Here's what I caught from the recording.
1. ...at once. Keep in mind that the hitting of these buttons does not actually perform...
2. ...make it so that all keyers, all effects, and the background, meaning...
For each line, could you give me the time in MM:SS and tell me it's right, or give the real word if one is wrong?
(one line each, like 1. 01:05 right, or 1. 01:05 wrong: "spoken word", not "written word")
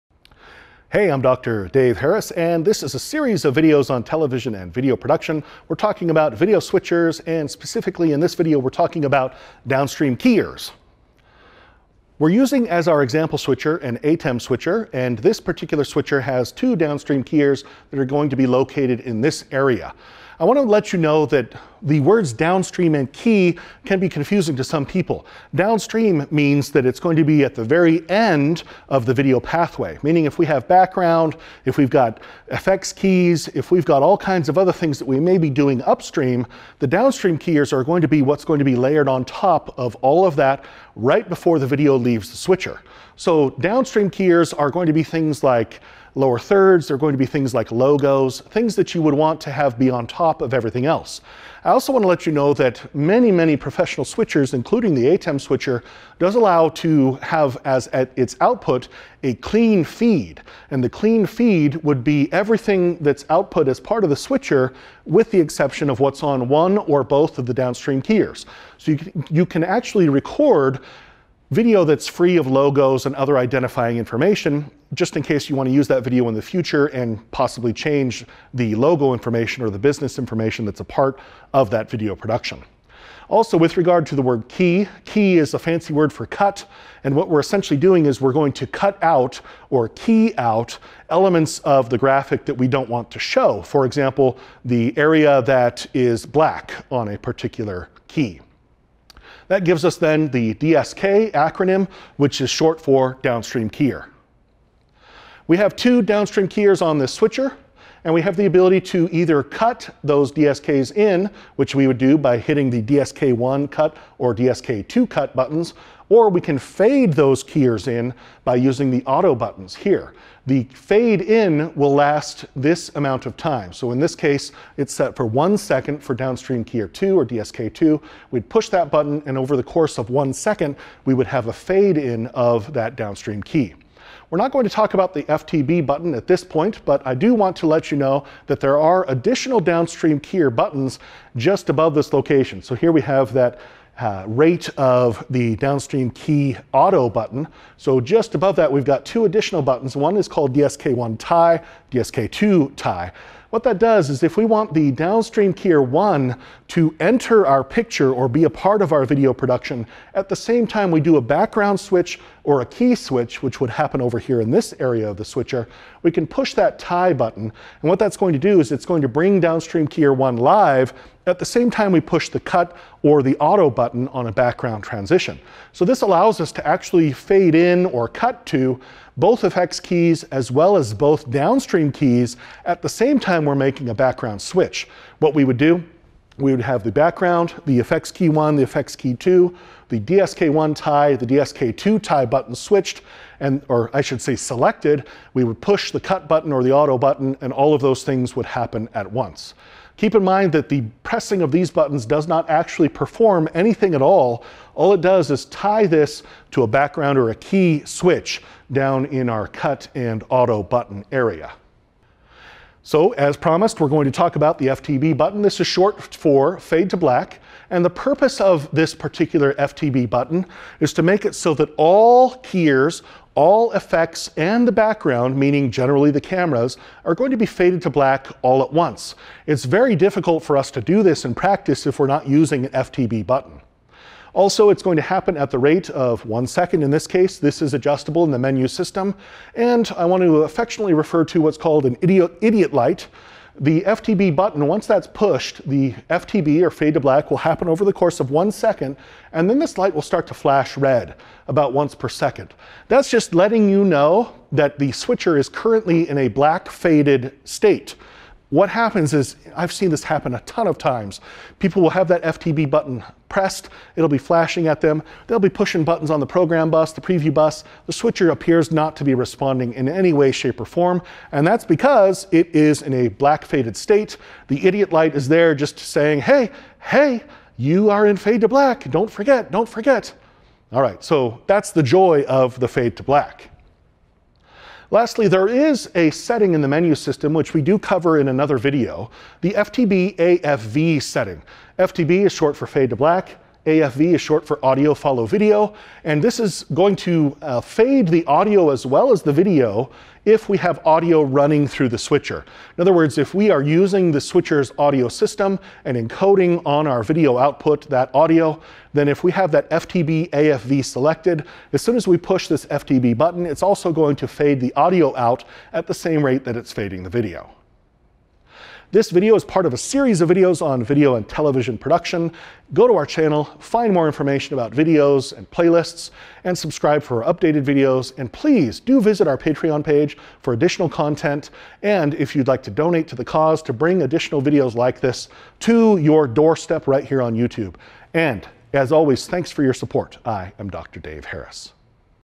1. 03:18 wrong: "pressing", not "hitting"
2. 03:41 right.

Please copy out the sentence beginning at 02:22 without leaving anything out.
So here we have that uh, rate of the downstream key auto button.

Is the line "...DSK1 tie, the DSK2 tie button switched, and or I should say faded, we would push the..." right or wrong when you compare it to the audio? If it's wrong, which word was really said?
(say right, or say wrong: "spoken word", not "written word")
wrong: "selected", not "faded".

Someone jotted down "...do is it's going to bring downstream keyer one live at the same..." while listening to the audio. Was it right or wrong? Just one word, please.
right.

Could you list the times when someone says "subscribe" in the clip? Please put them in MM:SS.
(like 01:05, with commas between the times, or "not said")
05:26.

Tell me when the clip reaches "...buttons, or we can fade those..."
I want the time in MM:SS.
01:55.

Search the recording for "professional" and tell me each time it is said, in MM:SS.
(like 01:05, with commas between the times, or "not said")
00:53.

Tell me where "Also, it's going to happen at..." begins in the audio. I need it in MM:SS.
03:54.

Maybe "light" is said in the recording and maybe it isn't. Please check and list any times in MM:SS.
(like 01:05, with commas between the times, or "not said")
04:02, 04:09, 04:34.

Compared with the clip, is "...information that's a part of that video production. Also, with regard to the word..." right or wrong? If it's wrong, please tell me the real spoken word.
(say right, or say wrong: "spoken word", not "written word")
right.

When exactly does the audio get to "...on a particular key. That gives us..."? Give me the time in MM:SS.
01:36.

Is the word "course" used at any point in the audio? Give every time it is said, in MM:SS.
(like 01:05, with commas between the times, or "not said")
02:09, 04:07.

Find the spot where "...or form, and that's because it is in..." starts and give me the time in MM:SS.
04:30.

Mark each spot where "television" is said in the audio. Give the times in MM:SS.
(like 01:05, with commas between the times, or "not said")
00:04, 05:21.